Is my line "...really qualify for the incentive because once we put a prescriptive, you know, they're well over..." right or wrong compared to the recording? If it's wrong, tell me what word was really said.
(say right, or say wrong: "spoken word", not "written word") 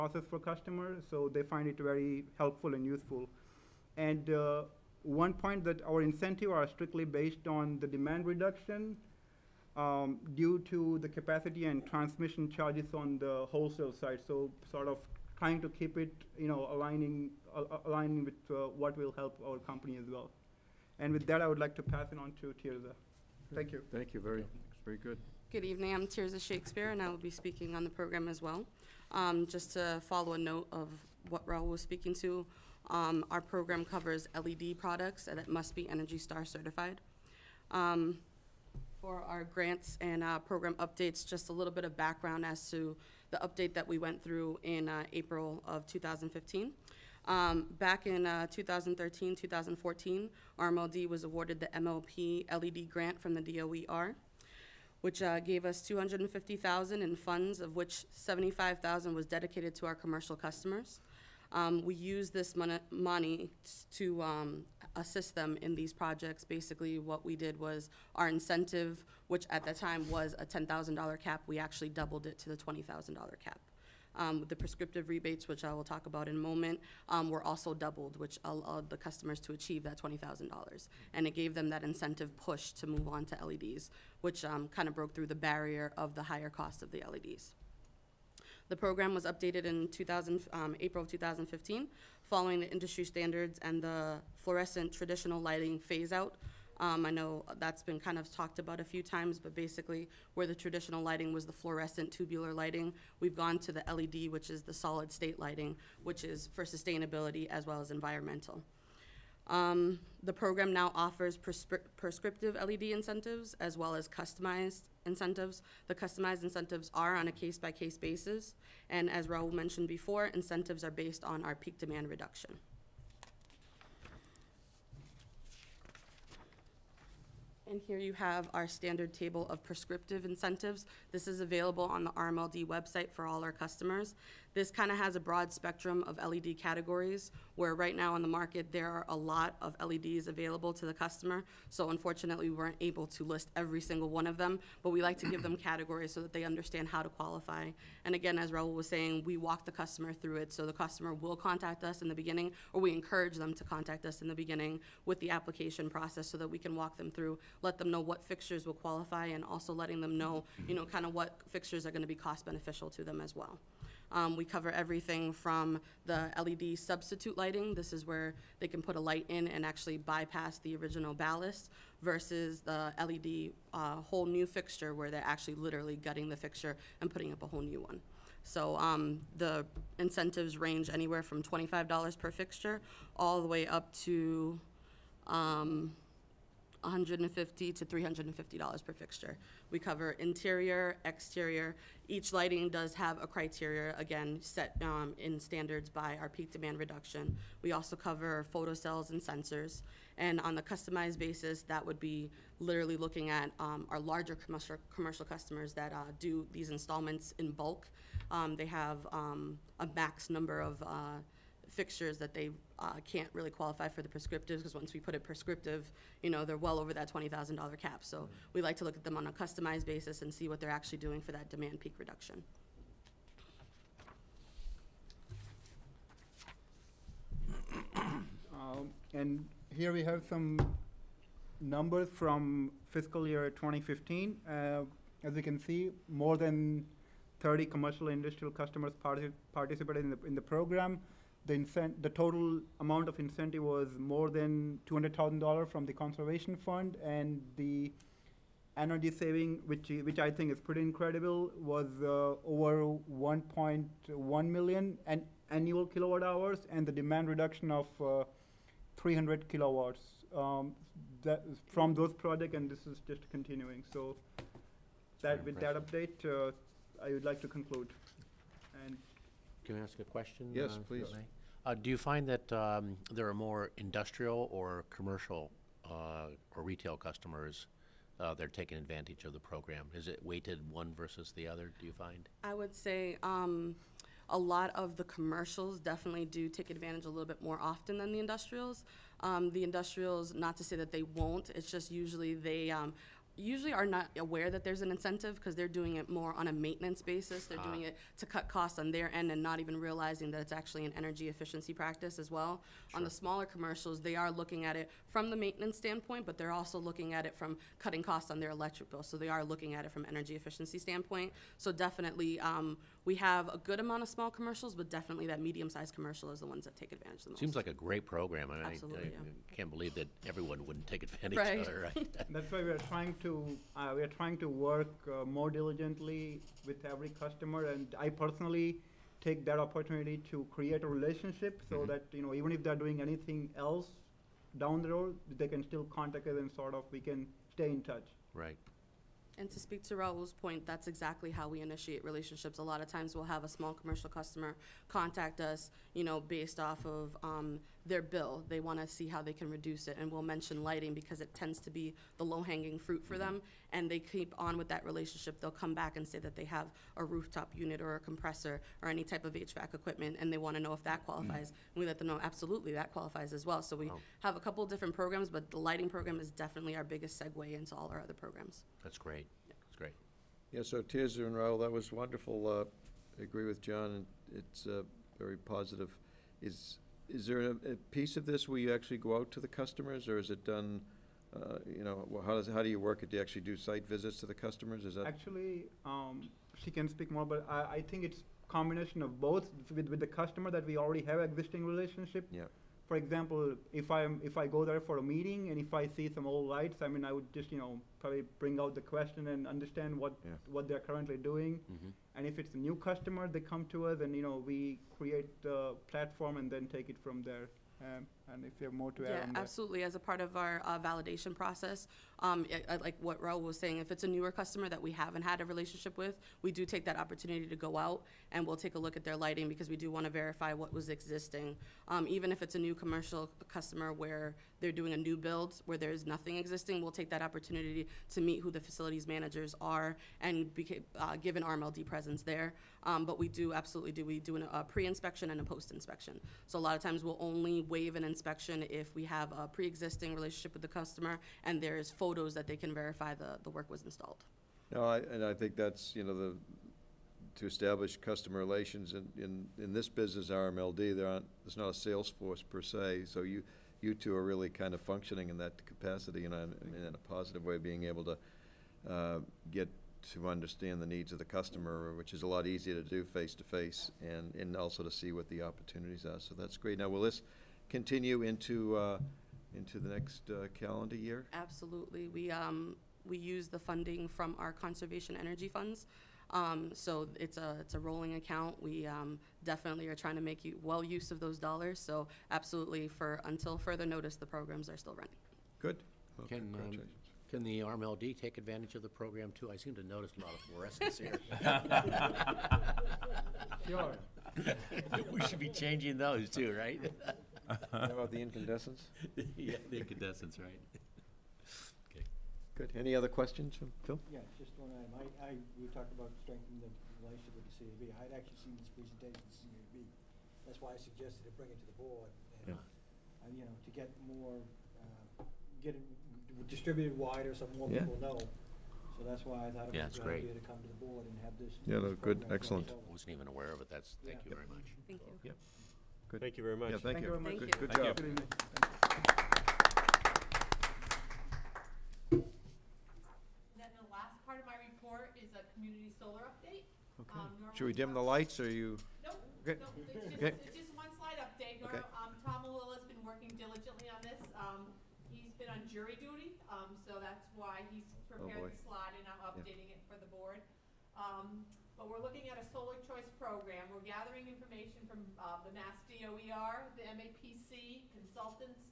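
wrong: "prescriptive", not "incentive".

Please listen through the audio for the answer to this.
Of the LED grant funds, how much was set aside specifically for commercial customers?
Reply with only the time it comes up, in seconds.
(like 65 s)
58 s.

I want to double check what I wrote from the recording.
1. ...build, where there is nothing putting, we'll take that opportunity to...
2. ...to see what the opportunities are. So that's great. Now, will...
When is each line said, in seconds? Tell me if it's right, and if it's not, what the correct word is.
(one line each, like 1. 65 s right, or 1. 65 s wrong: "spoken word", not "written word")
1. 425 s wrong: "existing", not "putting"
2. 464 s right.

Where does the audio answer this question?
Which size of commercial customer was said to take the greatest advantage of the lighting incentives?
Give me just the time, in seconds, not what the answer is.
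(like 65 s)
315 s.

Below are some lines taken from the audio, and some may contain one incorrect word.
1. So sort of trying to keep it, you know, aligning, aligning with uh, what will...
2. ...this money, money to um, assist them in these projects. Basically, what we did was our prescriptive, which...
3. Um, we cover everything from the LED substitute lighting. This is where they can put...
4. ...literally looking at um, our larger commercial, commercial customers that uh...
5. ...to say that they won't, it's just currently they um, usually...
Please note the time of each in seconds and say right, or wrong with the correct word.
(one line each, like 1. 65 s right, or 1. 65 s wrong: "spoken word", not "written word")
1. 14 s right
2. 62 s wrong: "incentive", not "prescriptive"
3. 164 s right
4. 202 s right
5. 290 s wrong: "usually", not "currently".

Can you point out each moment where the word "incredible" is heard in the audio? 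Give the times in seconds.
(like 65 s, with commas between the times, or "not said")
250 s.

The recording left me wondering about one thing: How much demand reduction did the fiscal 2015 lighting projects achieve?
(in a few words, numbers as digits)
300 kilowatts.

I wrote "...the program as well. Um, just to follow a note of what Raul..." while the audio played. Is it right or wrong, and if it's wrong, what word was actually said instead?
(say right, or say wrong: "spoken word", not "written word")
right.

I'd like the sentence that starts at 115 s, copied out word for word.
The customized incentives are on a case by case basis.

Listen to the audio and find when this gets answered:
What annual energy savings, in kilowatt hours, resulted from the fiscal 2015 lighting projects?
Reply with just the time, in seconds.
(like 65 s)
253 s.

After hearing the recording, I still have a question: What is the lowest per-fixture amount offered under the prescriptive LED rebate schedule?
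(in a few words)
$25.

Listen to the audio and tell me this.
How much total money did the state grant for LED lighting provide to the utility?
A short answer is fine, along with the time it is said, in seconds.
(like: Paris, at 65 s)
250,000, at 55 s.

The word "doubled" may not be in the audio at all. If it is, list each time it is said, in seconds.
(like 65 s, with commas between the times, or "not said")
71 s, 77 s.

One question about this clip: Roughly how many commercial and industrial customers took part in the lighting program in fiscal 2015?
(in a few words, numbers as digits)
more than 30.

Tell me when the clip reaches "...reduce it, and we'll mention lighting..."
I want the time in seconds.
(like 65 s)
349 s.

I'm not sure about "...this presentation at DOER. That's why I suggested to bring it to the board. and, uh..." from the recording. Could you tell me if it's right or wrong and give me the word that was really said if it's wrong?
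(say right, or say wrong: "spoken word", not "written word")
wrong: "CAB", not "DOER".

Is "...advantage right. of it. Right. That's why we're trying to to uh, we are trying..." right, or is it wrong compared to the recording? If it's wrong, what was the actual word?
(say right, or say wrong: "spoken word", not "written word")
right.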